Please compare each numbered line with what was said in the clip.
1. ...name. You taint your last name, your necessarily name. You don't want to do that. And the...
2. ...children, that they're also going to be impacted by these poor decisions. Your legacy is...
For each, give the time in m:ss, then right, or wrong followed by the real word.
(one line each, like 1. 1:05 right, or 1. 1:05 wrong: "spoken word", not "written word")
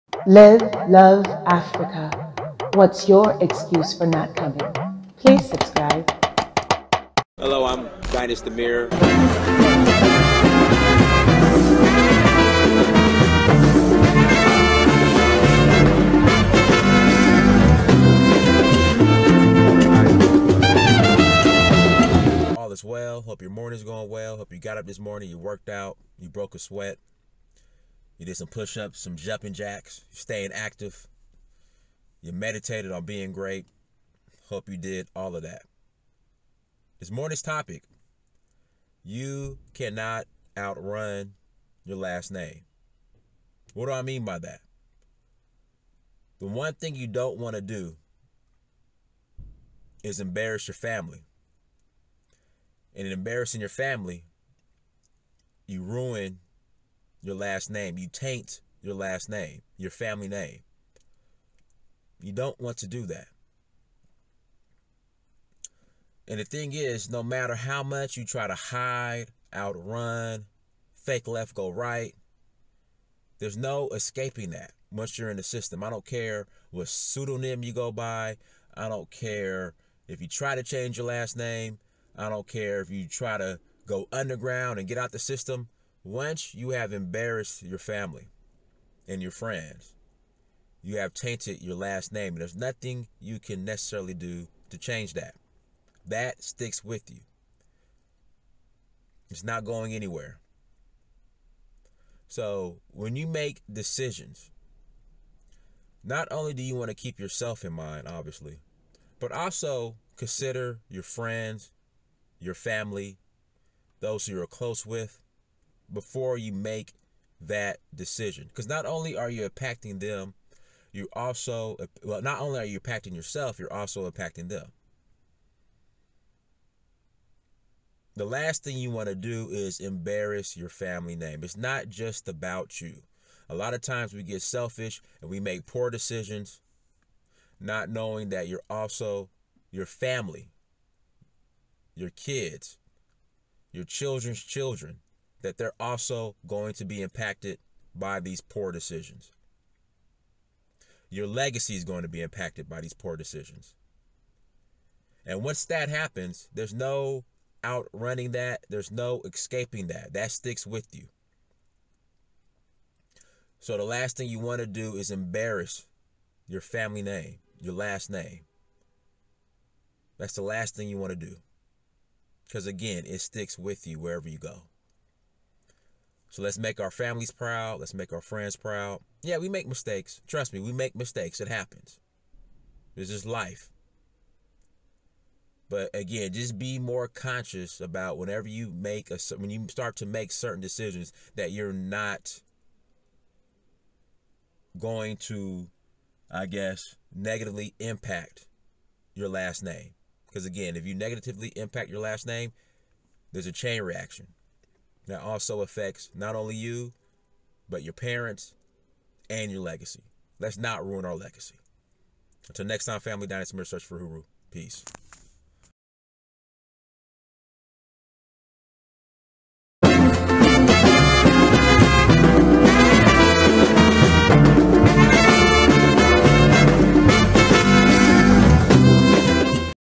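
1. 0:57 wrong: "family", not "necessarily"
2. 2:24 right.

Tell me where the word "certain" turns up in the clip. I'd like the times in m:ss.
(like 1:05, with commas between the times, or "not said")
3:10.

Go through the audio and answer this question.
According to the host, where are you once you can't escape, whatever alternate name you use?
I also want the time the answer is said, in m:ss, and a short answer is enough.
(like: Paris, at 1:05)
In the system, at 1:15.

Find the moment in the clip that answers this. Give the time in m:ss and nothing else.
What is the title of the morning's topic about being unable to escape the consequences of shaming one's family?
0:39.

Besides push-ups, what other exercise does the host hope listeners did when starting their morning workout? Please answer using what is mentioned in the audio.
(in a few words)
Jumping jacks.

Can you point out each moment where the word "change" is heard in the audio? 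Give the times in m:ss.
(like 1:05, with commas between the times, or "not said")
1:20, 1:34.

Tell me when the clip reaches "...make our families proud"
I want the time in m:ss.
2:56.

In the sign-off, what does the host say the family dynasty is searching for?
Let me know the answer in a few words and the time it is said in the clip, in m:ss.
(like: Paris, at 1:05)
Uhuru, at 3:33.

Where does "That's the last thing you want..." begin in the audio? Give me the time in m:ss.
2:50.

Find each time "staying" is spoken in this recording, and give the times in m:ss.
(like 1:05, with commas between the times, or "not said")
0:30.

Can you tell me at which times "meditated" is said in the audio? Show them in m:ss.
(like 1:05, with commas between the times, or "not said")
0:32.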